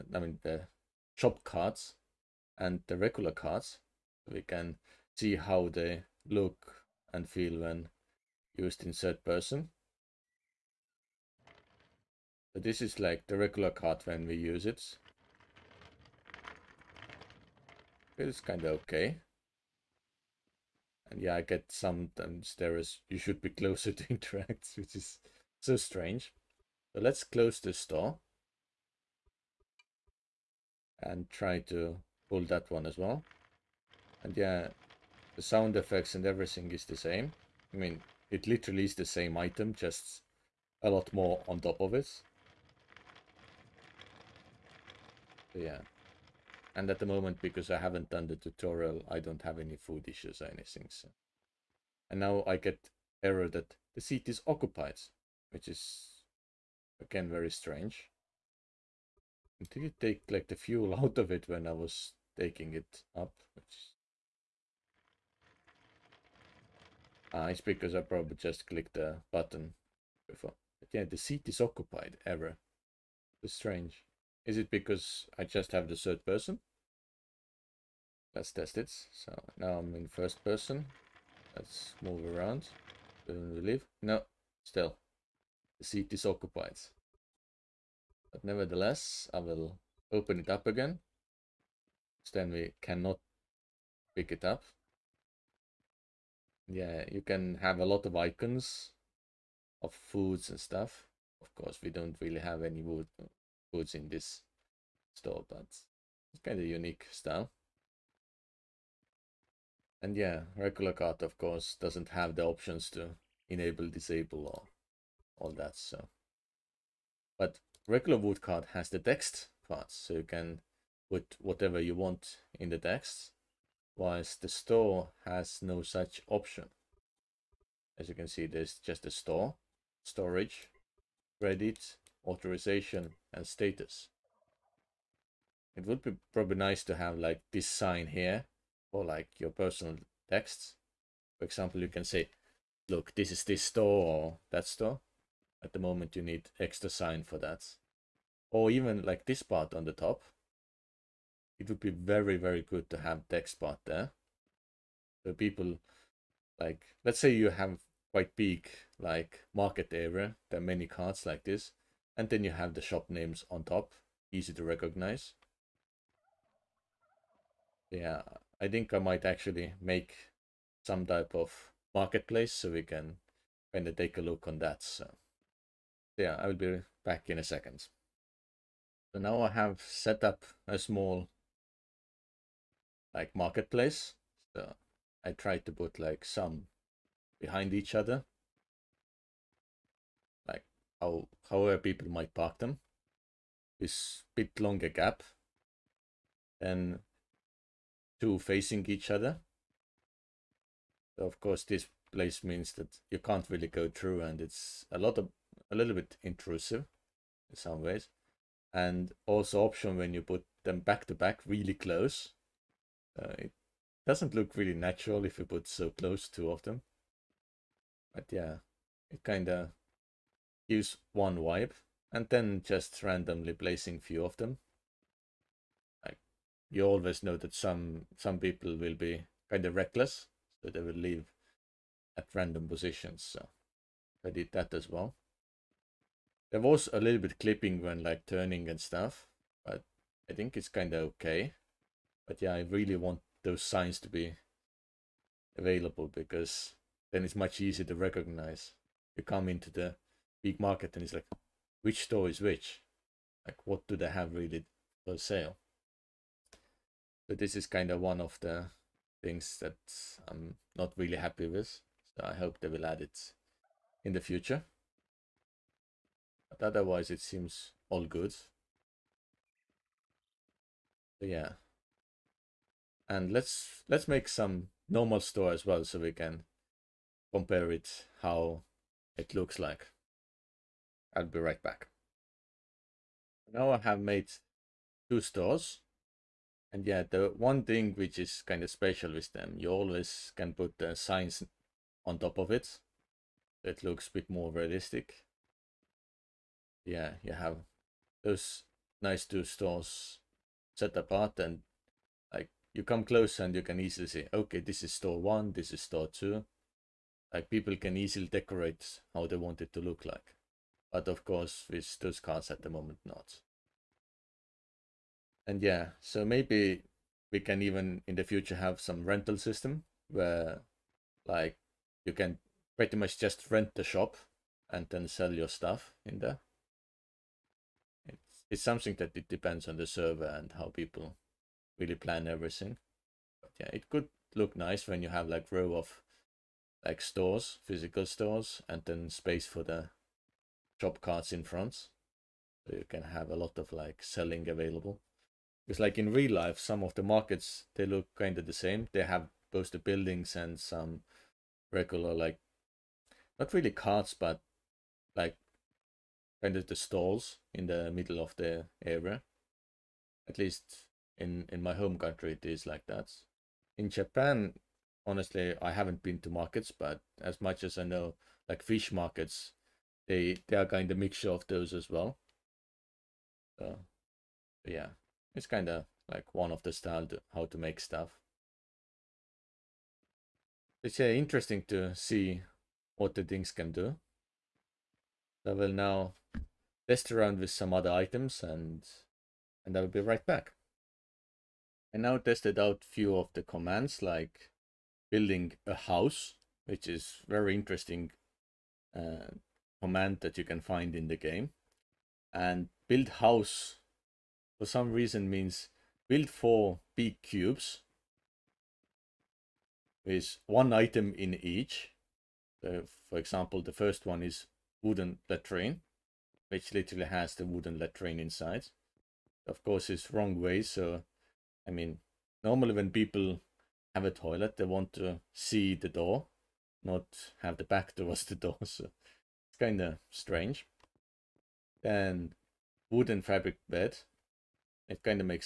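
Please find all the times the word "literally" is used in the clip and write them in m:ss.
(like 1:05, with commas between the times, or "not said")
0:38, 6:56.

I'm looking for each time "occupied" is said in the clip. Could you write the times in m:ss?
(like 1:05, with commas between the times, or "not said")
0:54, 1:11, 1:26.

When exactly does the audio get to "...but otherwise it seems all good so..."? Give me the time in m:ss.
4:26.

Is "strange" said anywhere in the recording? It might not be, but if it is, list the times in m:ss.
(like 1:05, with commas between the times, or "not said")
0:25, 0:57, 1:13, 7:10.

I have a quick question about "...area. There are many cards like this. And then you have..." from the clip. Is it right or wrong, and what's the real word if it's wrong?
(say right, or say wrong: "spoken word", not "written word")
right.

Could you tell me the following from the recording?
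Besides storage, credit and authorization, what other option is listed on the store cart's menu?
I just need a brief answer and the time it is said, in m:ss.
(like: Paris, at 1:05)
Status, at 2:13.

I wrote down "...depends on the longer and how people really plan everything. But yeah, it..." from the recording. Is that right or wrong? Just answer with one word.
wrong.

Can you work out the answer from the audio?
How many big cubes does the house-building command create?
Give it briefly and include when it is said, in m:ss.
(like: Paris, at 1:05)
4, at 6:46.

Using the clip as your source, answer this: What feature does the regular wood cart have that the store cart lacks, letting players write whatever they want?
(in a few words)
Text parts.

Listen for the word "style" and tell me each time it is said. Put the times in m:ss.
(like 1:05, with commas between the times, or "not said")
1:47, 6:16.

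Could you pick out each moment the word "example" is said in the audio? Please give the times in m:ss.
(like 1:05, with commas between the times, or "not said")
2:21, 6:53.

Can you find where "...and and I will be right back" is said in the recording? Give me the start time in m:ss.
6:28.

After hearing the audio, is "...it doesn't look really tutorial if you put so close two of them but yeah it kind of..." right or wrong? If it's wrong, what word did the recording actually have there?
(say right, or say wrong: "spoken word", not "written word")
wrong: "natural", not "tutorial".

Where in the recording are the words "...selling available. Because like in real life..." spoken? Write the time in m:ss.
5:44.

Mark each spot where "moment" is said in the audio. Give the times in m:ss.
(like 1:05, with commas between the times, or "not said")
0:47, 2:25, 5:12.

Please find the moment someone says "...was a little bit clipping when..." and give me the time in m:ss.
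3:56.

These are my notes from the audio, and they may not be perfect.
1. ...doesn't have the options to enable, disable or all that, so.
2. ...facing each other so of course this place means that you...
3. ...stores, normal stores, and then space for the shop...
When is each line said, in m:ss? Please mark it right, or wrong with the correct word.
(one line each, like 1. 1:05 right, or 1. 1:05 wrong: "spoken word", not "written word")
1. 1:51 right
2. 3:18 right
3. 5:37 wrong: "physical", not "normal".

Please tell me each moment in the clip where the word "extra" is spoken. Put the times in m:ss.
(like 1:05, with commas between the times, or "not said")
2:26.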